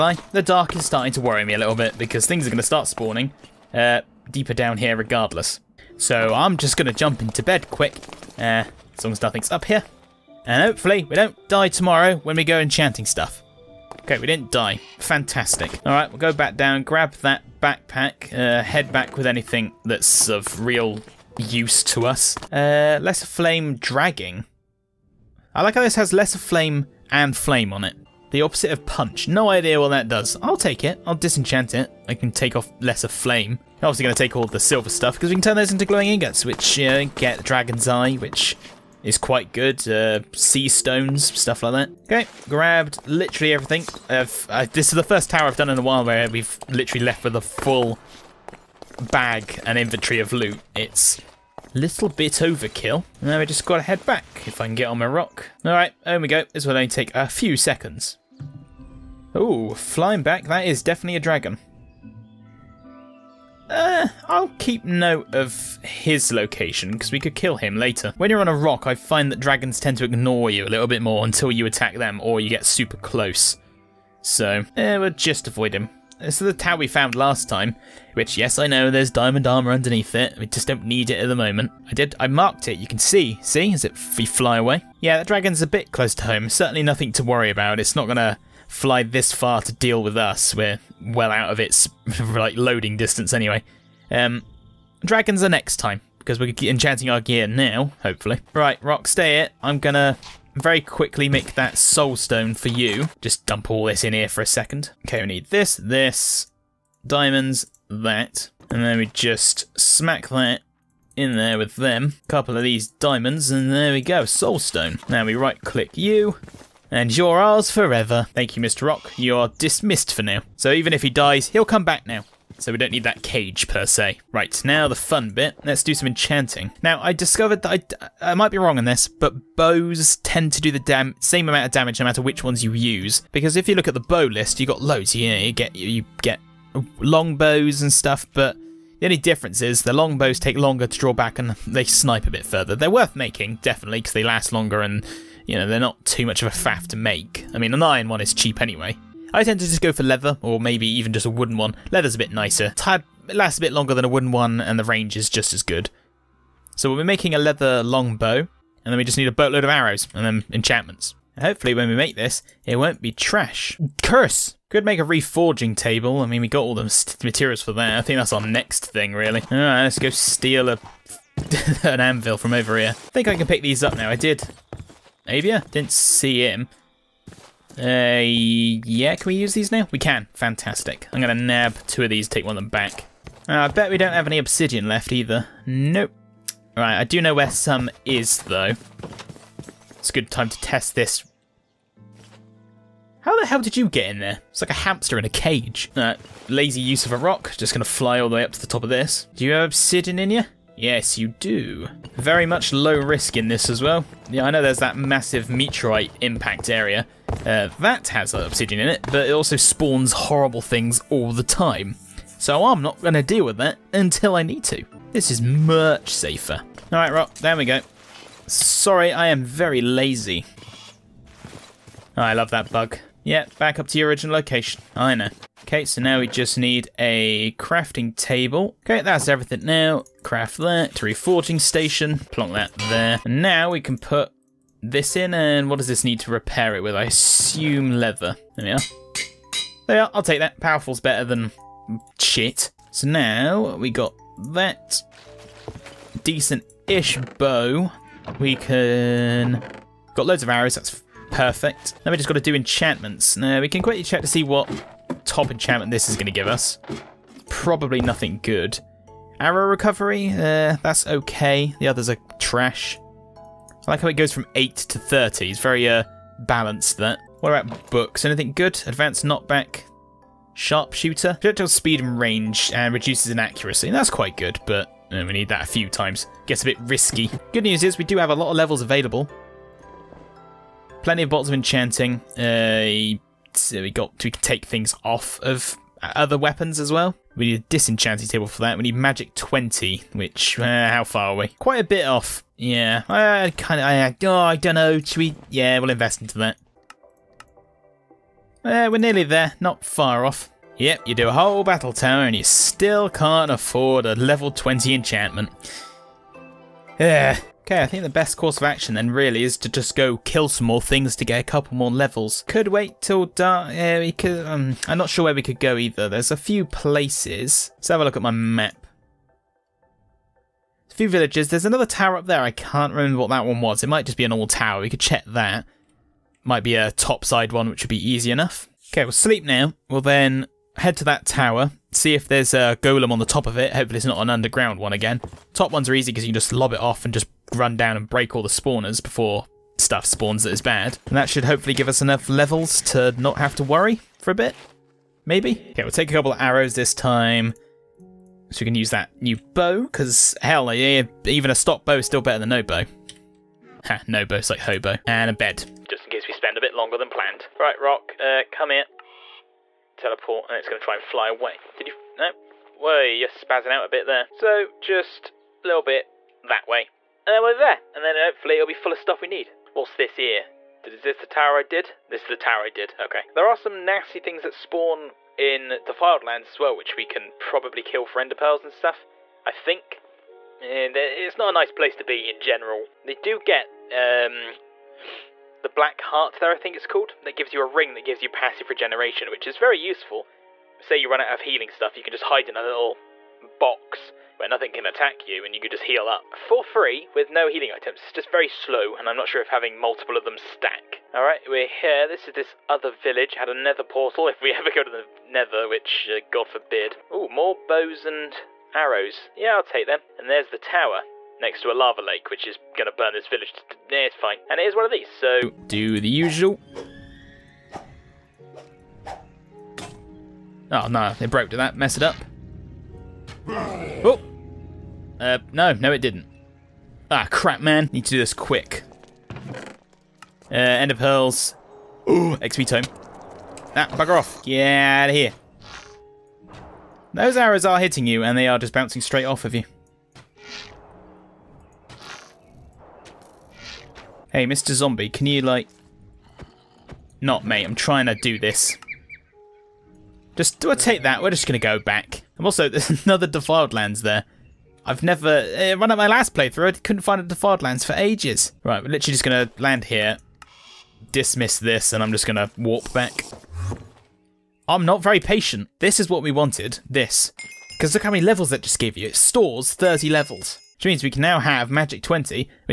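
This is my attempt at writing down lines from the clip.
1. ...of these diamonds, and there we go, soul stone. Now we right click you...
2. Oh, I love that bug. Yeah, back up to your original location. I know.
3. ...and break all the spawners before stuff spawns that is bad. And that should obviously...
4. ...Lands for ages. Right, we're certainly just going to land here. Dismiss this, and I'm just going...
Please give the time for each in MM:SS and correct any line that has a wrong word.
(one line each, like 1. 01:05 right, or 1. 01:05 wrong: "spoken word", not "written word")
1. 01:52 right
2. 03:42 right
3. 05:37 wrong: "hopefully", not "obviously"
4. 07:37 wrong: "literally", not "certainly".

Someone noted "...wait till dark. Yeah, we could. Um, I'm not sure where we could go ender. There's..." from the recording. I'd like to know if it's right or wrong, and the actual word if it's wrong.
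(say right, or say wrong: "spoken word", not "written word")
wrong: "either", not "ender".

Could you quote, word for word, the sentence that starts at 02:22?
They're worth making, definitely, because they last longer and, you know, they're not too much of a faff to make.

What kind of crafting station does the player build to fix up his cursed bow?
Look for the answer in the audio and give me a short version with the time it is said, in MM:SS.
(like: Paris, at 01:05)
reforging station, at 03:51.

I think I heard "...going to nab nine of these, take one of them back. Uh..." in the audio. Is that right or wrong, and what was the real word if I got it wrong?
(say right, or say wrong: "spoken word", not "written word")
wrong: "two", not "nine".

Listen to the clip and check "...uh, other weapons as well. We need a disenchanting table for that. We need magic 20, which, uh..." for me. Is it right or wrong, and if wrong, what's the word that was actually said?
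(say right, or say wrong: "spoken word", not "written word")
right.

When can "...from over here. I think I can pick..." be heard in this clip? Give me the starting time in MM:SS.
02:52.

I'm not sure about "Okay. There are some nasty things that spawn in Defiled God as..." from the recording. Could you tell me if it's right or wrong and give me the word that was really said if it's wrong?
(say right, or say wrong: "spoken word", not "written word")
wrong: "Lands", not "God".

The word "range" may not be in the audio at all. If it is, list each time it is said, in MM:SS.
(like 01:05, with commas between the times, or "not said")
02:34, 04:32.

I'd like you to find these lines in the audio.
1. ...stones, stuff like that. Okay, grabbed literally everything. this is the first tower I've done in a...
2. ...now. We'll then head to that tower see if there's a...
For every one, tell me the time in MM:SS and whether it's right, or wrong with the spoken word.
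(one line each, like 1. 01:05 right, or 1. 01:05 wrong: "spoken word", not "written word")
1. 00:40 right
2. 05:29 right.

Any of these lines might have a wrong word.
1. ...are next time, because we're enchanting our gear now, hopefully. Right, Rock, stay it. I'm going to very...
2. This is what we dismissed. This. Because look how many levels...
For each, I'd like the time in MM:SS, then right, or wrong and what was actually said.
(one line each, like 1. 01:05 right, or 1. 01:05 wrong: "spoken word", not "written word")
1. 01:35 right
2. 07:45 wrong: "wanted", not "dismissed".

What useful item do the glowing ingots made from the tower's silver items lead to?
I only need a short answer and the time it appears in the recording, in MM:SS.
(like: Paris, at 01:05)
dragon's eye, at 00:37.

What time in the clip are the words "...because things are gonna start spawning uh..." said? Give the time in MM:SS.
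00:01.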